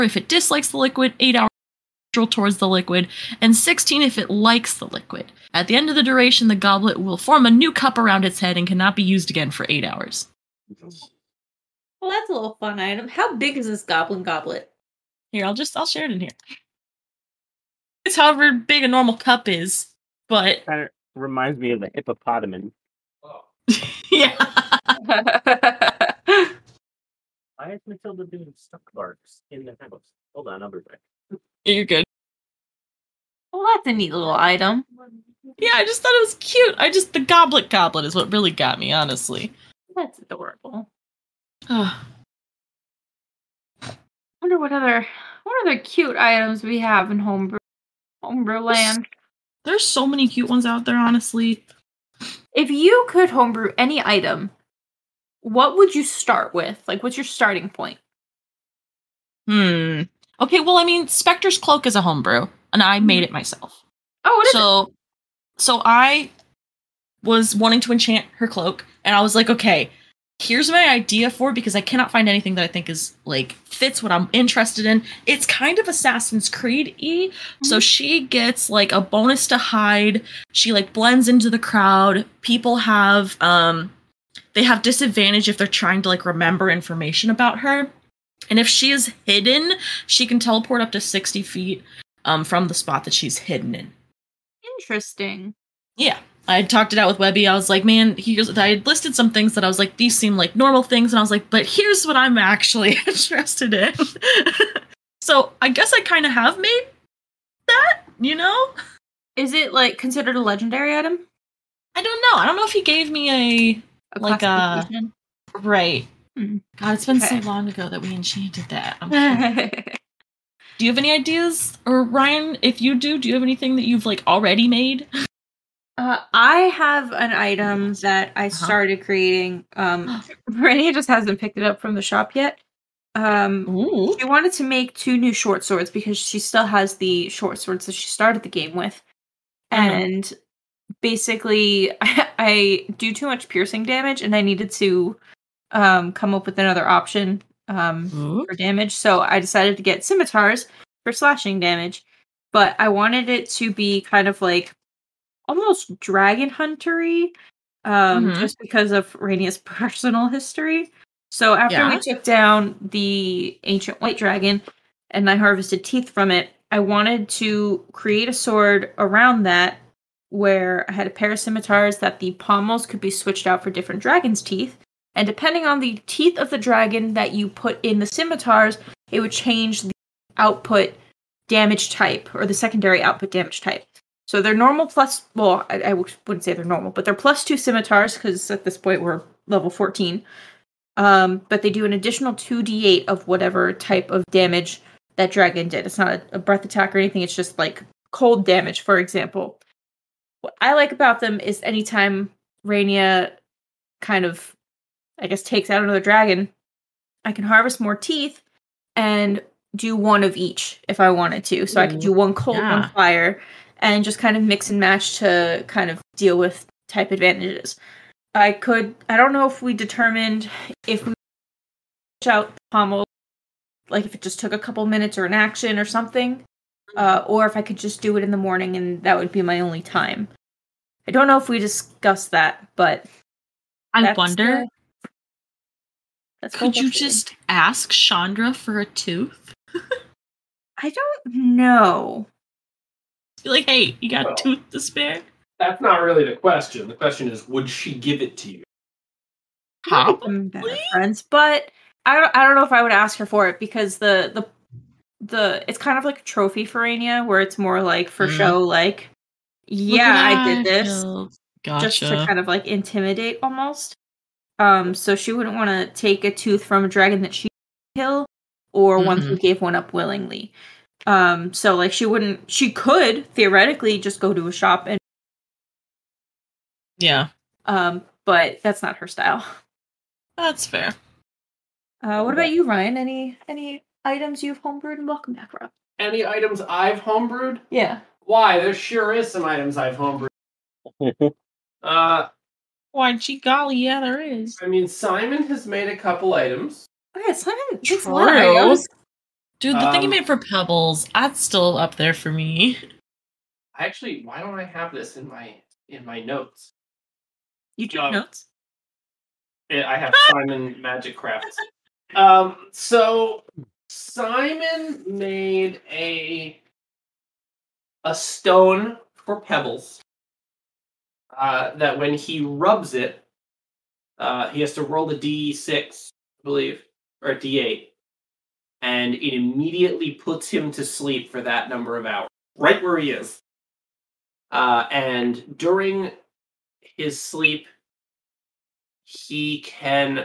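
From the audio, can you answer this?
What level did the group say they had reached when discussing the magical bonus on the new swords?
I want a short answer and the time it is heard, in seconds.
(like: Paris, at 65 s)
14, at 189 s.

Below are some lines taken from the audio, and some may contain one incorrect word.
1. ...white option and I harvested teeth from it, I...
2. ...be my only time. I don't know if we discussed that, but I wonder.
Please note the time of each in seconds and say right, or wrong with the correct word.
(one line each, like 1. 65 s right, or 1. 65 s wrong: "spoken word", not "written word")
1. 164 s wrong: "dragon", not "option"
2. 229 s right.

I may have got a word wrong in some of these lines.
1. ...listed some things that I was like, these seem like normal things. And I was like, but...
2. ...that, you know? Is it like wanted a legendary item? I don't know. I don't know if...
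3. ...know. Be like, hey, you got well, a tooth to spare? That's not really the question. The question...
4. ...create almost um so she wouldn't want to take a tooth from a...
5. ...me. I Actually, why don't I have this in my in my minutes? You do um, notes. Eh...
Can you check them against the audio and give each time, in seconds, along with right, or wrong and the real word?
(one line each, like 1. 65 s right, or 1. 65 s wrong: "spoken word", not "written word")
1. 98 s right
2. 107 s wrong: "considered", not "wanted"
3. 241 s right
4. 262 s wrong: "intimidate", not "create"
5. 302 s wrong: "notes", not "minutes".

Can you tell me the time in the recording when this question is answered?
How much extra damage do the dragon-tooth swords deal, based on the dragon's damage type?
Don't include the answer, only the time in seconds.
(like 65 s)
192 s.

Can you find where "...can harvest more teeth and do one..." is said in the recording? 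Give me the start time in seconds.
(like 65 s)
207 s.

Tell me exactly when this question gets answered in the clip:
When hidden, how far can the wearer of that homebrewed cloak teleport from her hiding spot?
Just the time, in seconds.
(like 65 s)
91 s.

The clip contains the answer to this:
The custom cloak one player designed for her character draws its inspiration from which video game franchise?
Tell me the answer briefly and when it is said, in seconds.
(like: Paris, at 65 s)
Assassin's Creed, at 75 s.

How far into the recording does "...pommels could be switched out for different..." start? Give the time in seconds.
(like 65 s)
172 s.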